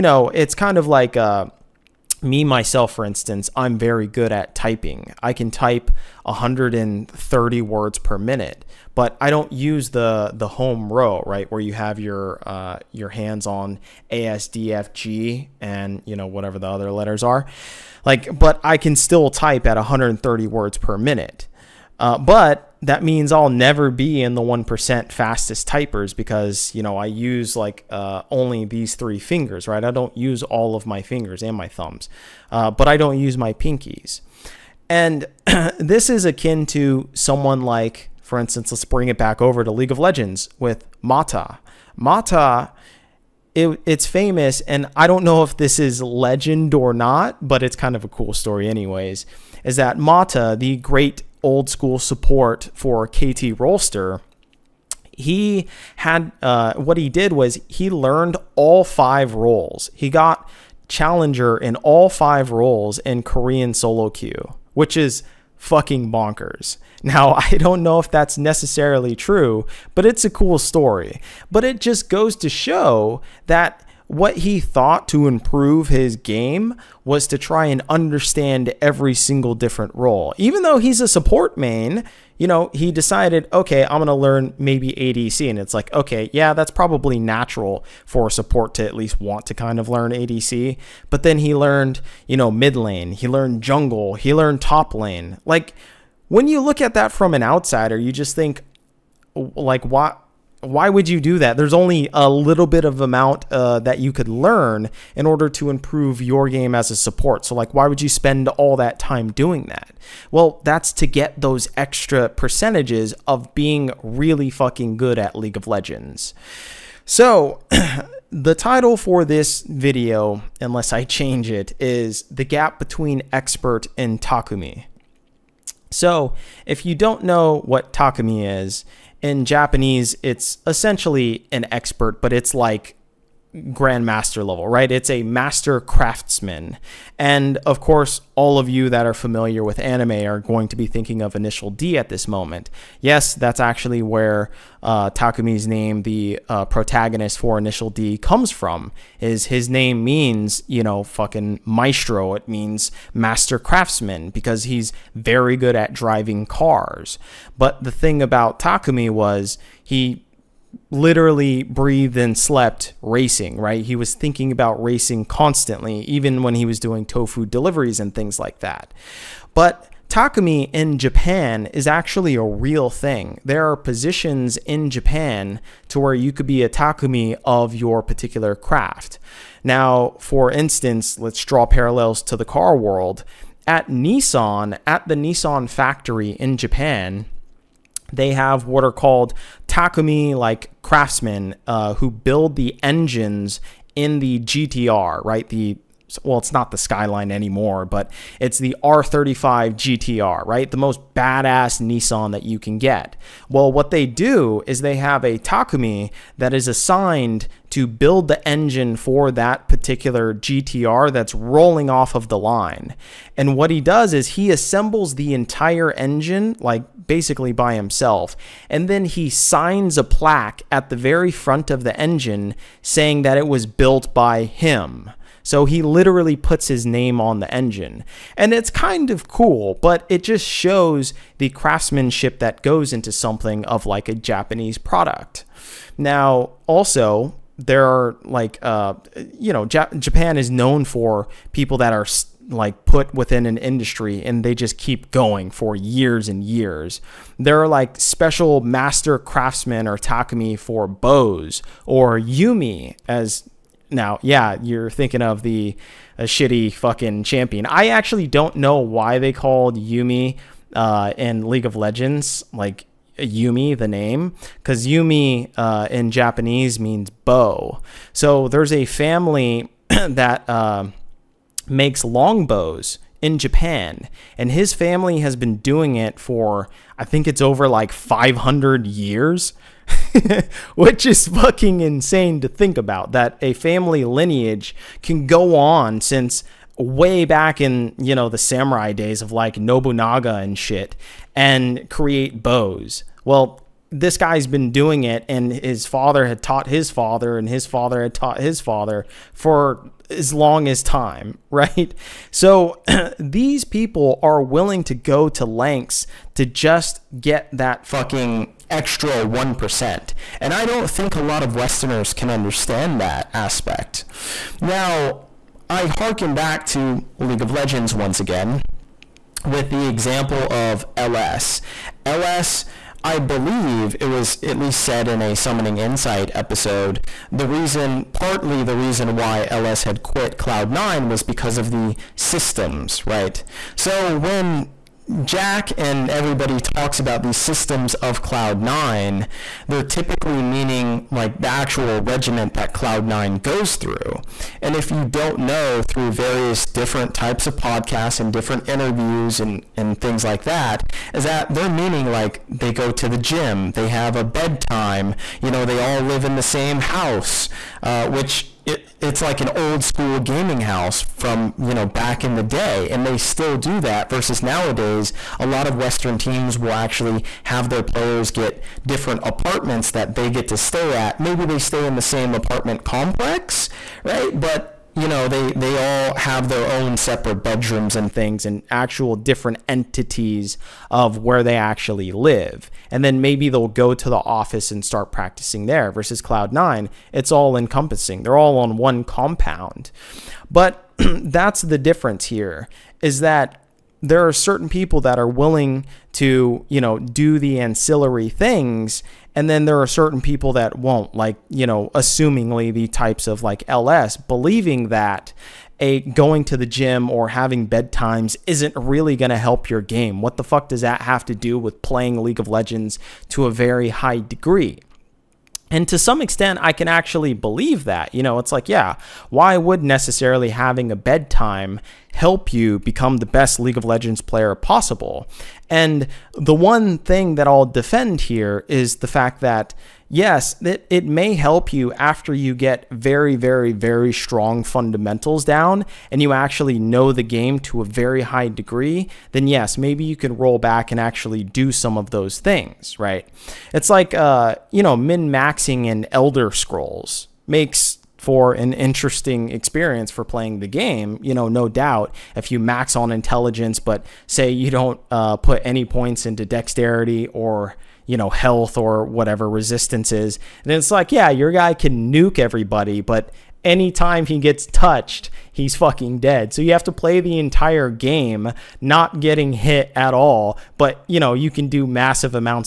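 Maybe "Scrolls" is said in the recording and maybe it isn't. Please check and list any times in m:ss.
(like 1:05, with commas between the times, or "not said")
7:26.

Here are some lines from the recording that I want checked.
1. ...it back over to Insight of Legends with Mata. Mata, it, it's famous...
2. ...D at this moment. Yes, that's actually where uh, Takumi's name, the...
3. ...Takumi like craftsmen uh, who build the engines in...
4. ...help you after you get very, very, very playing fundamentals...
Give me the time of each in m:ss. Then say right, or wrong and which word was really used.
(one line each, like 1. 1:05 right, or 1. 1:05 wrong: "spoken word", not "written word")
1. 0:39 wrong: "League", not "Insight"
2. 2:21 right
3. 3:09 right
4. 7:11 wrong: "strong", not "playing".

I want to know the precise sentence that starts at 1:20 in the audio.
Even though he's a support main, you know, he decided, okay, I'm going to learn maybe ADC.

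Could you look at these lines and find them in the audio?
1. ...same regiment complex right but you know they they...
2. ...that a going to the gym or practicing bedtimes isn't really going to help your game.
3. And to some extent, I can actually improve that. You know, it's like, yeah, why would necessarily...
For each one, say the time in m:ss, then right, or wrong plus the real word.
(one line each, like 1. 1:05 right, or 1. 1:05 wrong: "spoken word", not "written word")
1. 6:12 wrong: "apartment", not "regiment"
2. 6:44 wrong: "having", not "practicing"
3. 6:55 wrong: "believe", not "improve".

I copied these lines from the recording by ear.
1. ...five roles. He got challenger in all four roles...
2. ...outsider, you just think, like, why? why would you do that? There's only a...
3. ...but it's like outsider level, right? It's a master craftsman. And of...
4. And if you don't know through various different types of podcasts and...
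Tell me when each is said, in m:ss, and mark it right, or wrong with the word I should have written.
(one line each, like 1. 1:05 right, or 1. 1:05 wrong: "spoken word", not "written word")
1. 0:58 wrong: "five", not "four"
2. 1:37 right
3. 2:12 wrong: "grandmaster", not "outsider"
4. 5:44 right.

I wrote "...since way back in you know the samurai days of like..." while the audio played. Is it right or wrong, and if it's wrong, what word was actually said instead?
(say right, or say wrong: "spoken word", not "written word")
right.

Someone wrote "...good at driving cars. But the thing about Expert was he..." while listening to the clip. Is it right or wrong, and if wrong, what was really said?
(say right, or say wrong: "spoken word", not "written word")
wrong: "Takumi", not "Expert".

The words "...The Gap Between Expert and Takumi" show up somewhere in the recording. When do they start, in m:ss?
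2:02.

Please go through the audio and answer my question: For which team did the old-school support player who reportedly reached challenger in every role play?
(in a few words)
KT Rolster.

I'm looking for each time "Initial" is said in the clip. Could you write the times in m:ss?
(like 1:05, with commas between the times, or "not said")
2:21, 2:27.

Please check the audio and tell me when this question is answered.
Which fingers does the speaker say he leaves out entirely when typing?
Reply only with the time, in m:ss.
0:33.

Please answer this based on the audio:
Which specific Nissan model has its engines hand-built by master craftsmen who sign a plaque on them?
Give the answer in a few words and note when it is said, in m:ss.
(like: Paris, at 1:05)
R35 GTR, at 3:18.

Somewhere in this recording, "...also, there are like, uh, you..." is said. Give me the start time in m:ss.
3:56.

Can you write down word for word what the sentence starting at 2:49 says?
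But Takumi in Japan is actually a real thing.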